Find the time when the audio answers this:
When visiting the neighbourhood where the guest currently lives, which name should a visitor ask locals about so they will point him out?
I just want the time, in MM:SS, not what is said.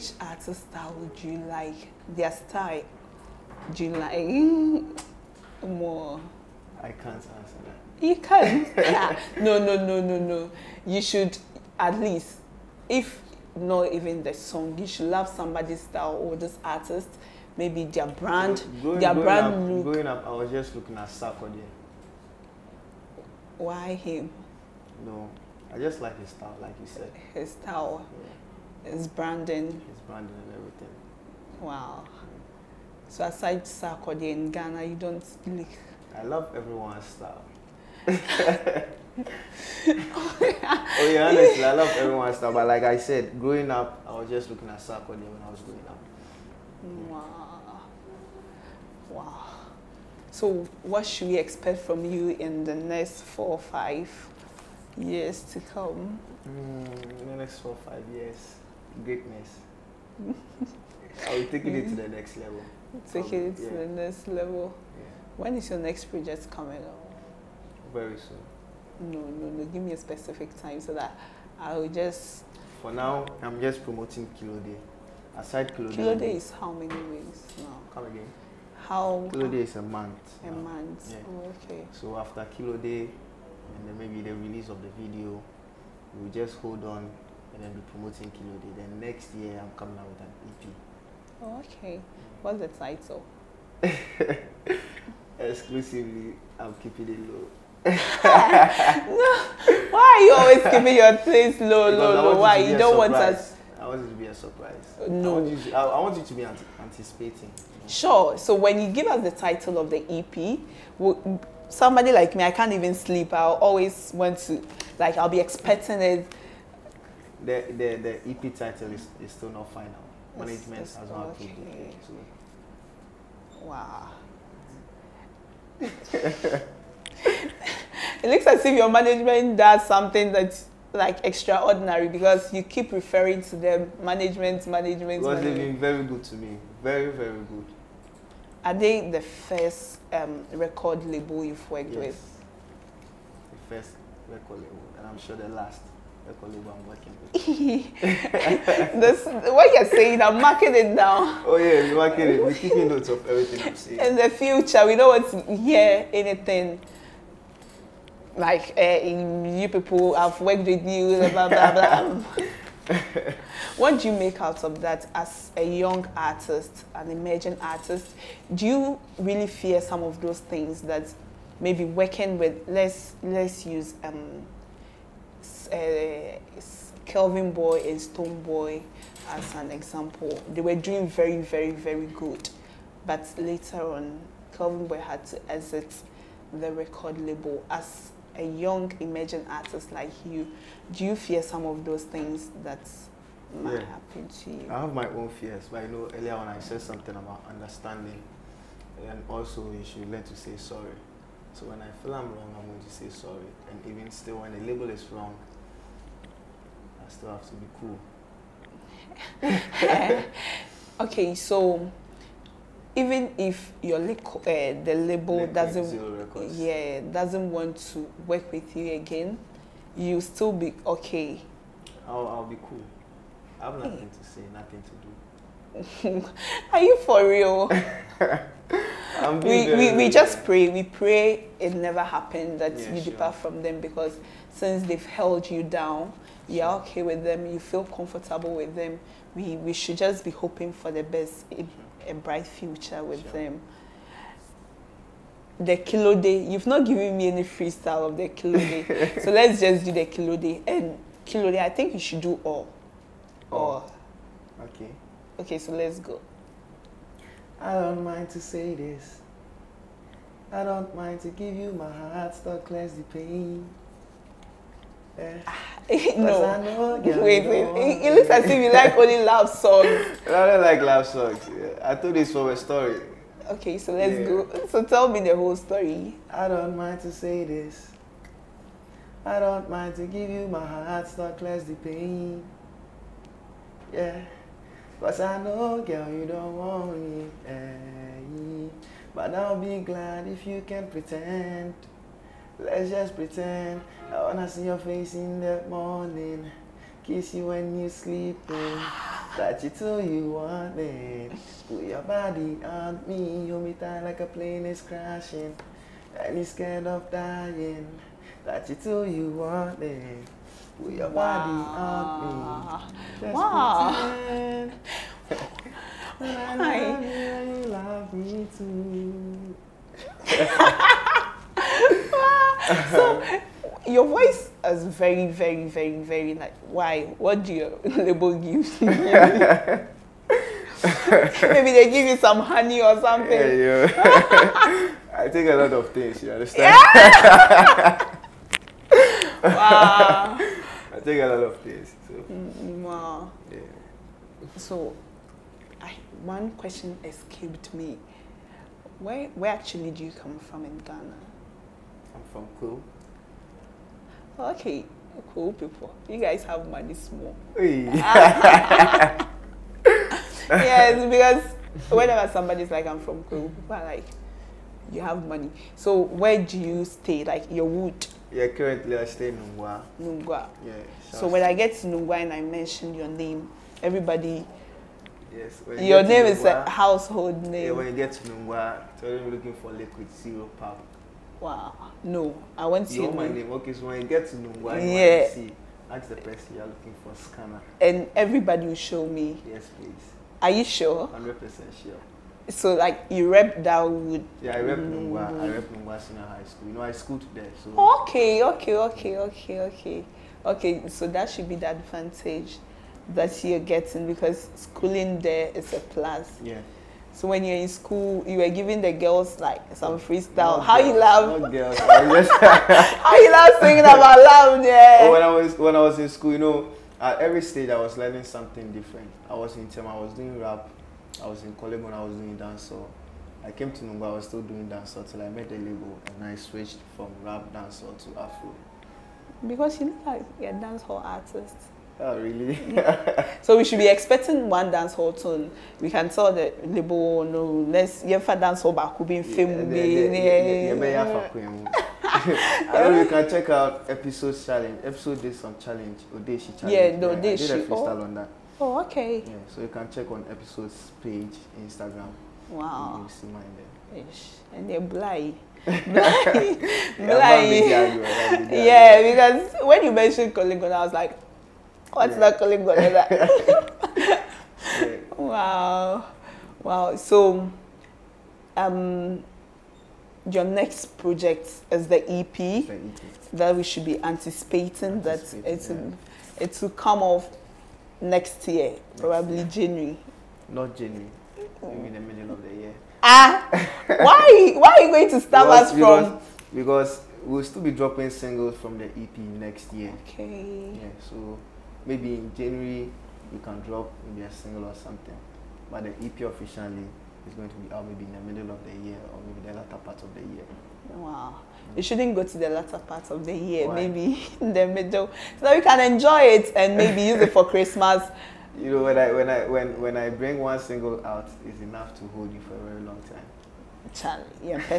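06:27.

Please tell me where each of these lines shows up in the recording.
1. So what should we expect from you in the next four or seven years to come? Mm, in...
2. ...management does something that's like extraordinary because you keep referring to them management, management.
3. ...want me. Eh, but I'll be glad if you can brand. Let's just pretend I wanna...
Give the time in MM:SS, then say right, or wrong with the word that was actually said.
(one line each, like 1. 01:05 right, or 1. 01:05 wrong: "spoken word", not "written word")
1. 00:50 wrong: "five", not "seven"
2. 02:08 right
3. 04:46 wrong: "pretend", not "brand".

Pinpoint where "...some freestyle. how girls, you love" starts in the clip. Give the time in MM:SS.
06:49.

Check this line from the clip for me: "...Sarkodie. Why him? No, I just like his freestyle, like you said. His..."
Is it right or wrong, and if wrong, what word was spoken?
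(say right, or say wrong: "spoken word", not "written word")
wrong: "style", not "freestyle".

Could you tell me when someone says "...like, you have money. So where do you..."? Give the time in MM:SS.
06:03.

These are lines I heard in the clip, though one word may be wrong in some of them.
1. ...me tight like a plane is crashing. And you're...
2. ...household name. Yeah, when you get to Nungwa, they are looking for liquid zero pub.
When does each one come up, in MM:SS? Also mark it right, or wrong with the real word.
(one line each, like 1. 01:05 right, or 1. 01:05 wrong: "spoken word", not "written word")
1. 05:03 right
2. 06:16 right.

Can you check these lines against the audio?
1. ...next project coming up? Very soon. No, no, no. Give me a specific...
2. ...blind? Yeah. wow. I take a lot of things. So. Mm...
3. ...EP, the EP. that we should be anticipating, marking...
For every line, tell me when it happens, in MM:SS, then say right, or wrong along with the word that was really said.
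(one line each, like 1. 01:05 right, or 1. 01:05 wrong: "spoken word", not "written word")
1. 01:05 right
2. 05:36 wrong: "understand", not "blind"
3. 07:52 wrong: "anticipating", not "marking".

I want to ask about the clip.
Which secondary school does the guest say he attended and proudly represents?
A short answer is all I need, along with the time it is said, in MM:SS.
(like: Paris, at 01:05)
Nungwa Senior High School, at 06:35.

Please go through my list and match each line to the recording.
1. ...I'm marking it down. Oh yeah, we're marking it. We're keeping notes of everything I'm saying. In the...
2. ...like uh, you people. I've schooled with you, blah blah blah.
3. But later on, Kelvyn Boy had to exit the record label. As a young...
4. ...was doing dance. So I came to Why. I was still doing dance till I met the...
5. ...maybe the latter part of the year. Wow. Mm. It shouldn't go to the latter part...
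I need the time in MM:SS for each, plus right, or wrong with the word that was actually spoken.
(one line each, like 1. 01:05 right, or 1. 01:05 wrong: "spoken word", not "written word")
1. 02:30 right
2. 02:38 wrong: "worked", not "schooled"
3. 03:03 right
4. 07:02 wrong: "Numba", not "Why"
5. 08:19 right.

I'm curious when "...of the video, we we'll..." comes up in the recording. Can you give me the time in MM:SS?
01:24.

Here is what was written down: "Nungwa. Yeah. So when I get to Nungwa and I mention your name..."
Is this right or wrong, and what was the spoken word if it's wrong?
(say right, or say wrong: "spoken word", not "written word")
right.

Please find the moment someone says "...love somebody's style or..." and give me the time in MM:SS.
00:15.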